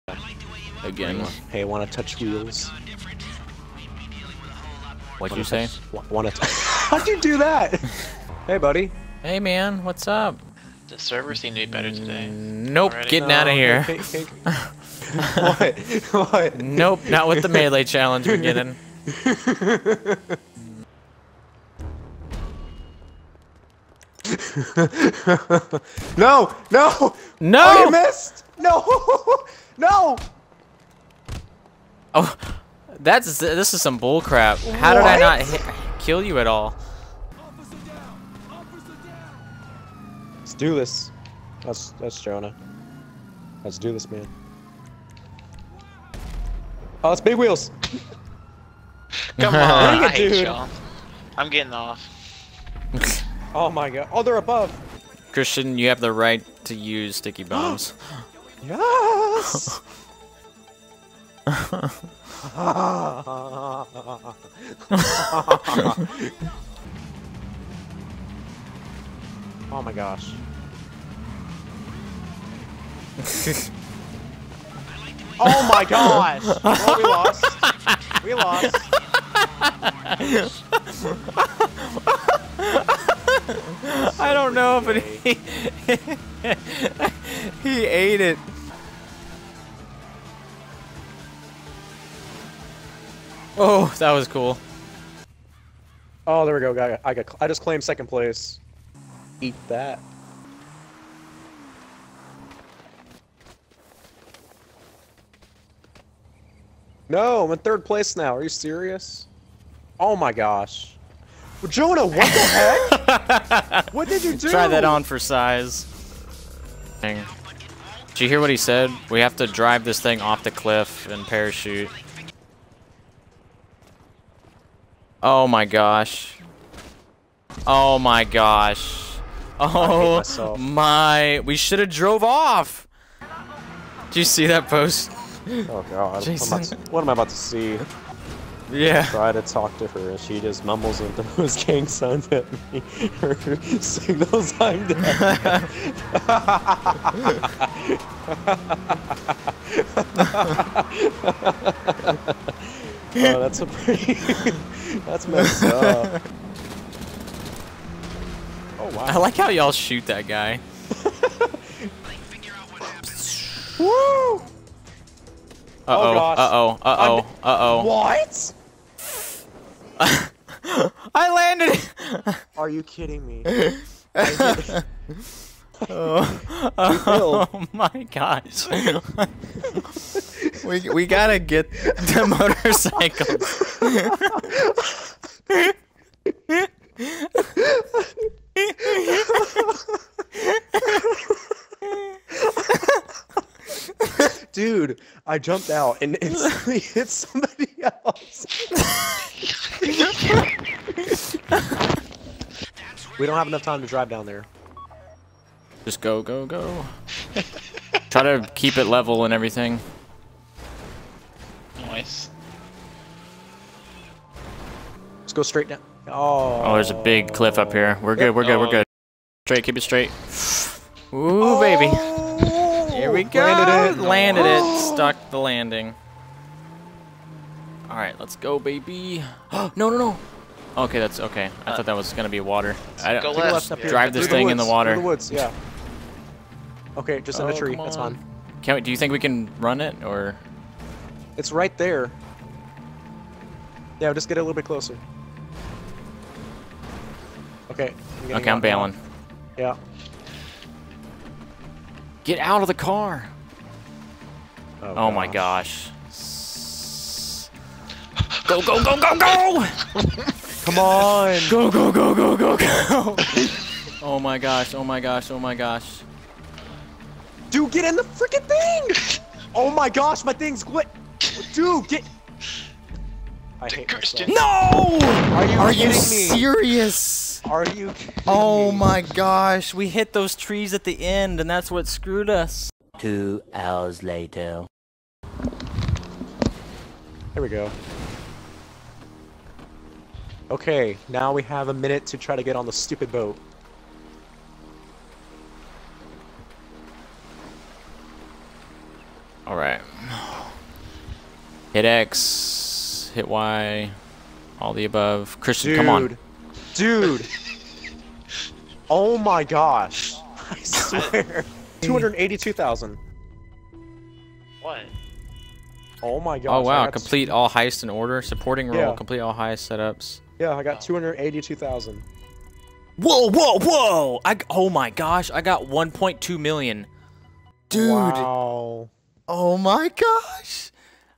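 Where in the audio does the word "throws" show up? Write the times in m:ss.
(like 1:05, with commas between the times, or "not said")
2:21.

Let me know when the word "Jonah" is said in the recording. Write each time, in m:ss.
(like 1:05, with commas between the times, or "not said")
0:42, 1:51.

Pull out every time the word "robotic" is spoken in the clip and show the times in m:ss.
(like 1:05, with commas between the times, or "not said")
not said.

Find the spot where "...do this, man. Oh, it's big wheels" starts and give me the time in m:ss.
0:43.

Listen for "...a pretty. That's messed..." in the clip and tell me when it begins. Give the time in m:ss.
2:33.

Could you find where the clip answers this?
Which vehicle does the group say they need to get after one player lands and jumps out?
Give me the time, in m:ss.
3:02.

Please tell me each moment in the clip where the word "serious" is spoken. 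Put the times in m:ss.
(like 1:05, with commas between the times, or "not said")
1:48, 4:35.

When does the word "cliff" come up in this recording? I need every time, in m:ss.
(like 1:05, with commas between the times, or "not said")
2:00, 3:37.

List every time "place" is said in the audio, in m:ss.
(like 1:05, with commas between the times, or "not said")
1:38, 1:47.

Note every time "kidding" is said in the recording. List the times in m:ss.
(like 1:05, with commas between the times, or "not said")
2:52.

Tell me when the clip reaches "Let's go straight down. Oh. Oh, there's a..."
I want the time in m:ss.
3:35.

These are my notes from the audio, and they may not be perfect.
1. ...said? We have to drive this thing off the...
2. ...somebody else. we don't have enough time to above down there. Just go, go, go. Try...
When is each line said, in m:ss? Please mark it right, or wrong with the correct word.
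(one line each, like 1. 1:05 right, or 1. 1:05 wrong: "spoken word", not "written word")
1. 1:58 right
2. 3:17 wrong: "drive", not "above".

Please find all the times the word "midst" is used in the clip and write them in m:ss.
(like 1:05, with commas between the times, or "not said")
not said.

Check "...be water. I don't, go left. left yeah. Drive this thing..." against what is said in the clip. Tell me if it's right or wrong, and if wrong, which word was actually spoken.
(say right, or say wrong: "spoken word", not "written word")
right.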